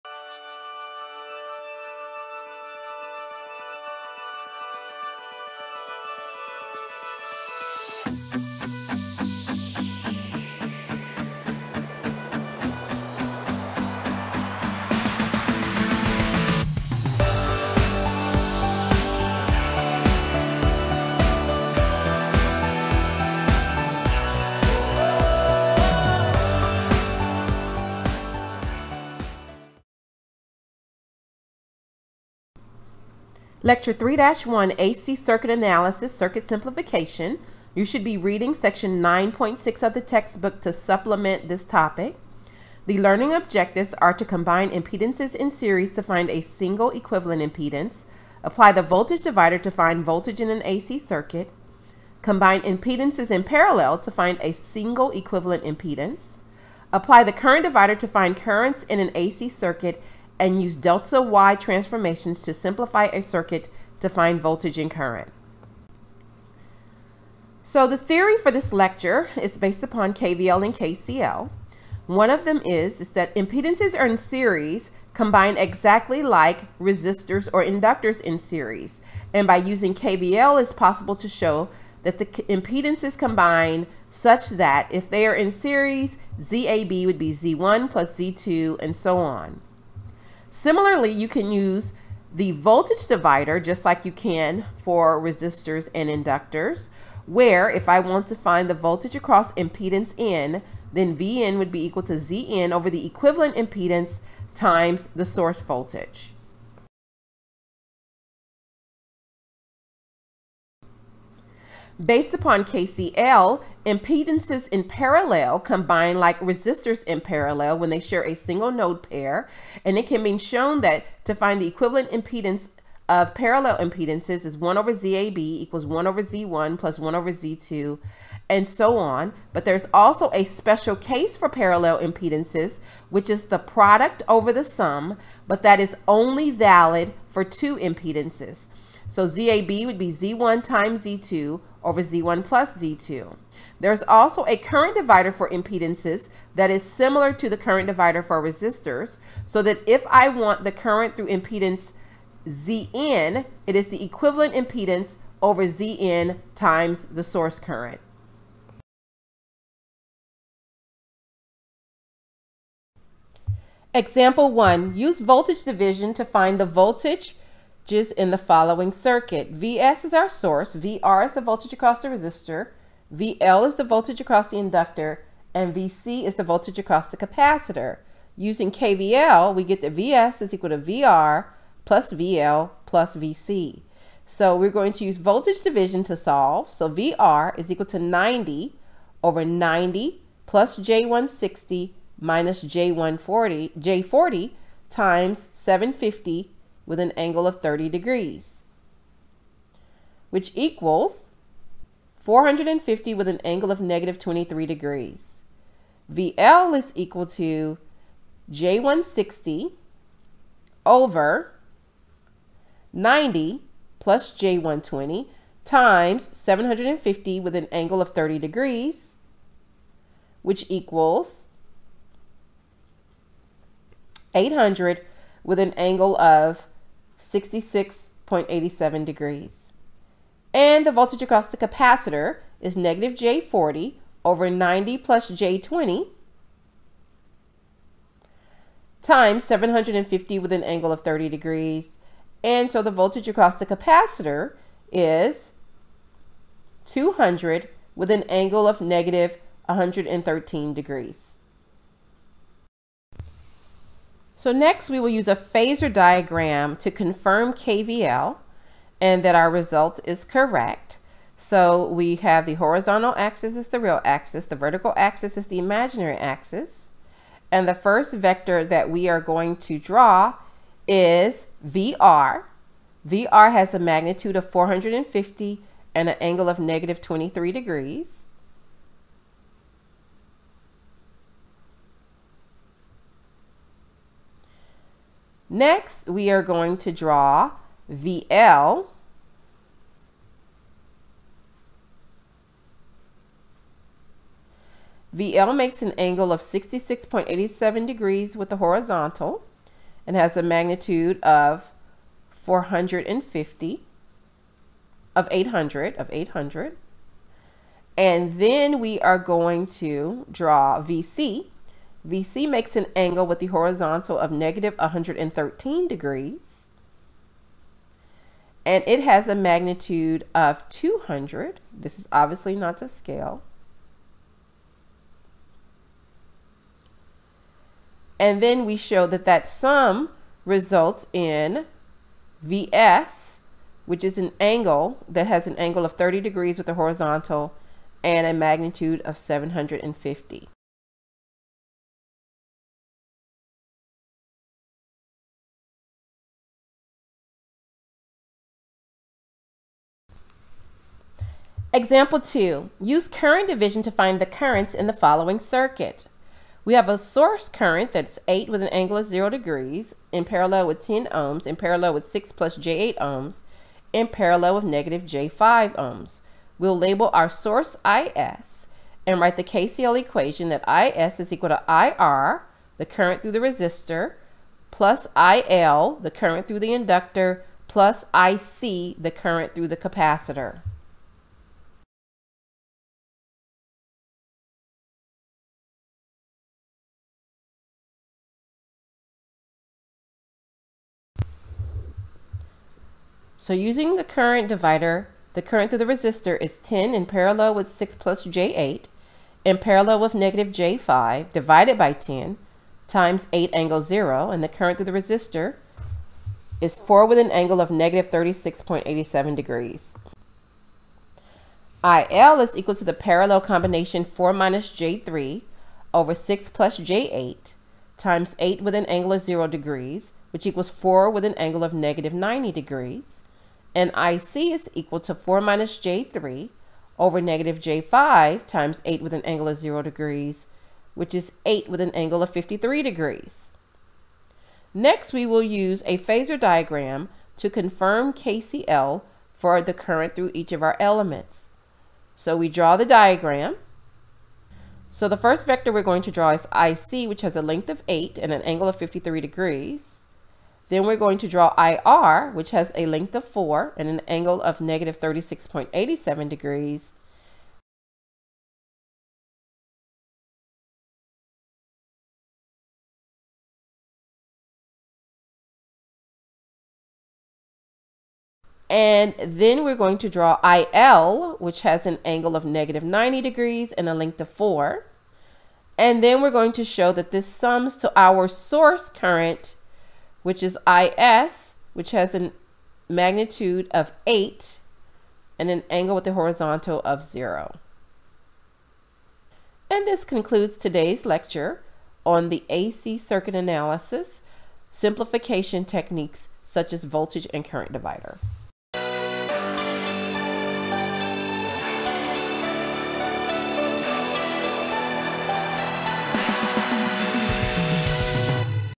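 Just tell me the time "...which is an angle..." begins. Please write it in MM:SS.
05:33.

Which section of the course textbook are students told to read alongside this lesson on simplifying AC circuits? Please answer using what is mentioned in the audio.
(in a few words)
9.6.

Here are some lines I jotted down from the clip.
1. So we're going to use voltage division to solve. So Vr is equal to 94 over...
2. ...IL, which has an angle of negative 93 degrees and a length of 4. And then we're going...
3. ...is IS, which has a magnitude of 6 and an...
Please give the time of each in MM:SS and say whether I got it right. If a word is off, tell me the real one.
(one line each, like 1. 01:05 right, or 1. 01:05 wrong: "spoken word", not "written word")
1. 03:04 wrong: "90", not "94"
2. 07:50 wrong: "90", not "93"
3. 08:00 wrong: "8", not "6".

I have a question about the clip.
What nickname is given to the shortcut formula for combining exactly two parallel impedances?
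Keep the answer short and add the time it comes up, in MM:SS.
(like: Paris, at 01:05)
product over the sum, at 02:13.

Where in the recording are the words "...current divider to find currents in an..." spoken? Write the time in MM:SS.
00:57.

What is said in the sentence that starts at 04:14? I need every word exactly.
So next we will use a phasor diagram to confirm KVL and that our result is correct.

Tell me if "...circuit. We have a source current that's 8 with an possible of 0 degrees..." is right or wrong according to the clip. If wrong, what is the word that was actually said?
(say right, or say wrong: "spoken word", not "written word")
wrong: "angle", not "possible".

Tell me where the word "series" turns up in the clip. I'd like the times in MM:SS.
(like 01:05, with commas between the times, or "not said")
00:45, 01:14, 01:18, 01:25.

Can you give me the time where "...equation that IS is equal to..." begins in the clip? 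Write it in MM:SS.
06:09.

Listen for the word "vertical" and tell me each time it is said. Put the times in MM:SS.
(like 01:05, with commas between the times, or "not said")
04:24.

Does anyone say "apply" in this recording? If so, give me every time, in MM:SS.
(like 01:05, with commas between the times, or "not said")
00:48, 00:56.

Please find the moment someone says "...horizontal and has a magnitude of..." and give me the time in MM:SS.
04:58.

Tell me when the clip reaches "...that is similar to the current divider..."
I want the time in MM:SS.
02:26.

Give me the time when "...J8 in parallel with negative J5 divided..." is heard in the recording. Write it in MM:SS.
06:38.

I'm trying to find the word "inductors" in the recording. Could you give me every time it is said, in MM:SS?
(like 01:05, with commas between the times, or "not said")
01:17, 01:36, 02:54, 06:16.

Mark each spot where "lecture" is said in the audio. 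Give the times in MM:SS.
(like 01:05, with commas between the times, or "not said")
00:33, 01:08, 08:11.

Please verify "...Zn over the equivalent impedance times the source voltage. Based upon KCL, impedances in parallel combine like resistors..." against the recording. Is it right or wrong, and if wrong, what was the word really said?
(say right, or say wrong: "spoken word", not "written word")
right.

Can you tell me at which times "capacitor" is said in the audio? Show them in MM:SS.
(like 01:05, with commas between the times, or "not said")
02:57, 03:51, 04:03, 06:19.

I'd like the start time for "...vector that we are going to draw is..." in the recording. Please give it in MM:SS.
04:28.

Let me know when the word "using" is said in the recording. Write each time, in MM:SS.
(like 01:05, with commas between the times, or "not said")
01:19, 02:58, 06:33.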